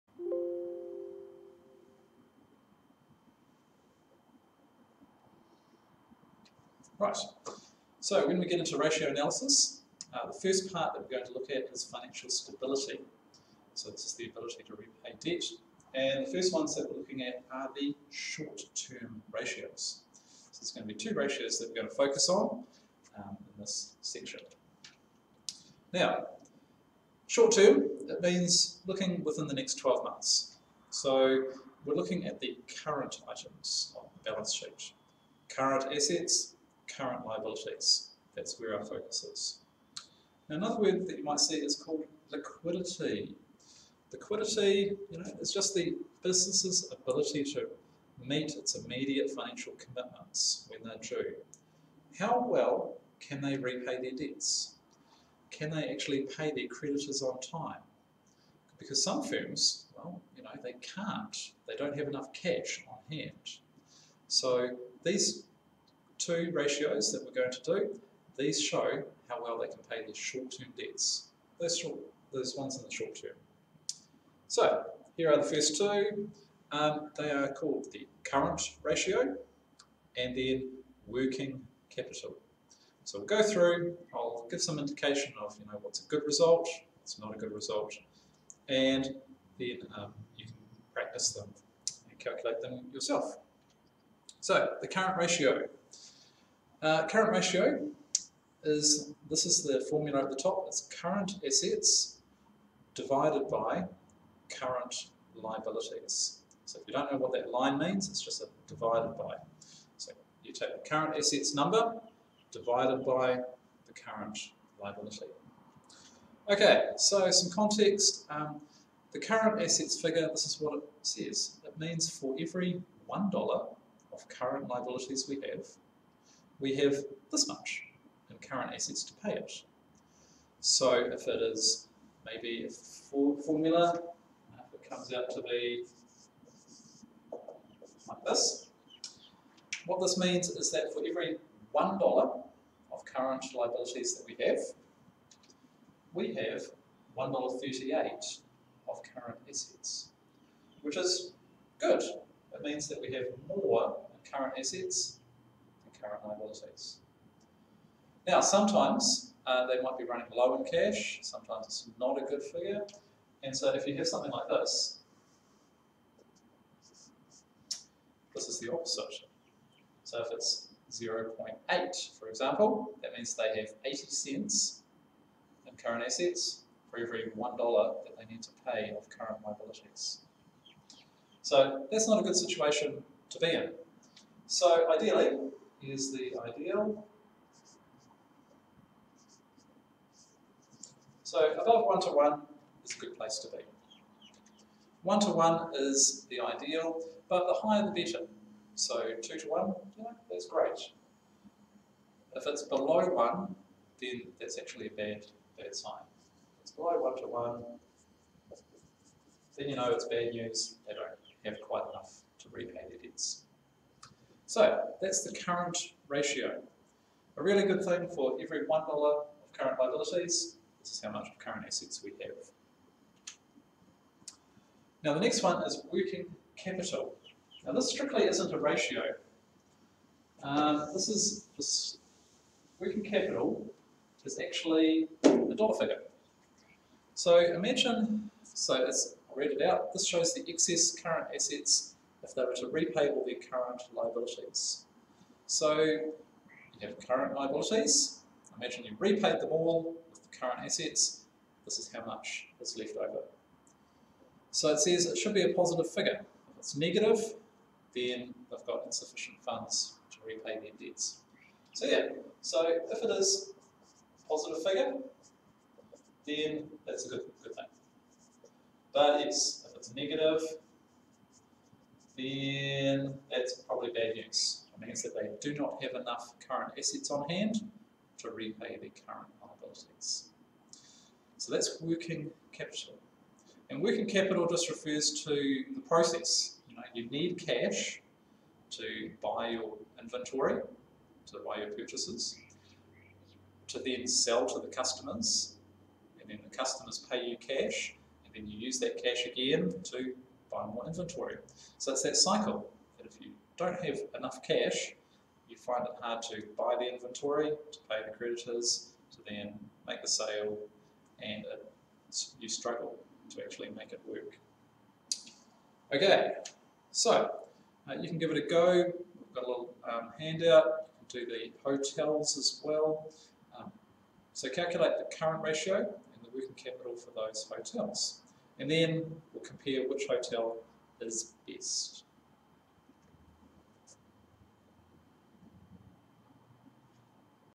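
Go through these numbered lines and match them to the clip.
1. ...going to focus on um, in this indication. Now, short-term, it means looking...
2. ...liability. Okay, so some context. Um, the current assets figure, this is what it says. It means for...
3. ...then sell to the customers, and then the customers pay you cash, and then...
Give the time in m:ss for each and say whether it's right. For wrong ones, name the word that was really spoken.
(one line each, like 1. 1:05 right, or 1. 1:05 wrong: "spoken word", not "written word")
1. 0:21 wrong: "section", not "indication"
2. 1:54 right
3. 4:53 right.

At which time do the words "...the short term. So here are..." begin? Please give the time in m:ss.
1:12.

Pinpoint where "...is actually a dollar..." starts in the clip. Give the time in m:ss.
3:54.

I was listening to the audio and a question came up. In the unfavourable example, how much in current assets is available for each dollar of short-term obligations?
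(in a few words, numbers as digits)
80 cents.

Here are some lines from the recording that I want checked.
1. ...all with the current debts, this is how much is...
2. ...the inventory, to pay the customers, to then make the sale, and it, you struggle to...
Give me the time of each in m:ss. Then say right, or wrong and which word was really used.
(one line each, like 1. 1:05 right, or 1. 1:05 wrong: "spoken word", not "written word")
1. 4:09 wrong: "assets", not "debts"
2. 5:06 wrong: "creditors", not "customers".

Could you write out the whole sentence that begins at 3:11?
So above one-to-one is a good place to be.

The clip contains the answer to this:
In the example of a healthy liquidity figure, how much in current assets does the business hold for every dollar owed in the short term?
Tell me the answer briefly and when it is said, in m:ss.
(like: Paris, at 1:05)
$1.38, at 2:27.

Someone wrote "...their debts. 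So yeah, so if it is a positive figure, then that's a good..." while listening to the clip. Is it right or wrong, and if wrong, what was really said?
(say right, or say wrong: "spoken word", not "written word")
right.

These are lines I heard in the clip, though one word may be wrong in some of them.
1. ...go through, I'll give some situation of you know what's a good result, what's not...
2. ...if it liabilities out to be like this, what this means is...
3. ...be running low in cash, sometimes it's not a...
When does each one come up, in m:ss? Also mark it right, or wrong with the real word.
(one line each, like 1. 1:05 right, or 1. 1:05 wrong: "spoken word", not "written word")
1. 1:23 wrong: "indication", not "situation"
2. 2:14 wrong: "comes", not "liabilities"
3. 2:39 right.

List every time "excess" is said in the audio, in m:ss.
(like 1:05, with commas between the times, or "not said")
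4:00.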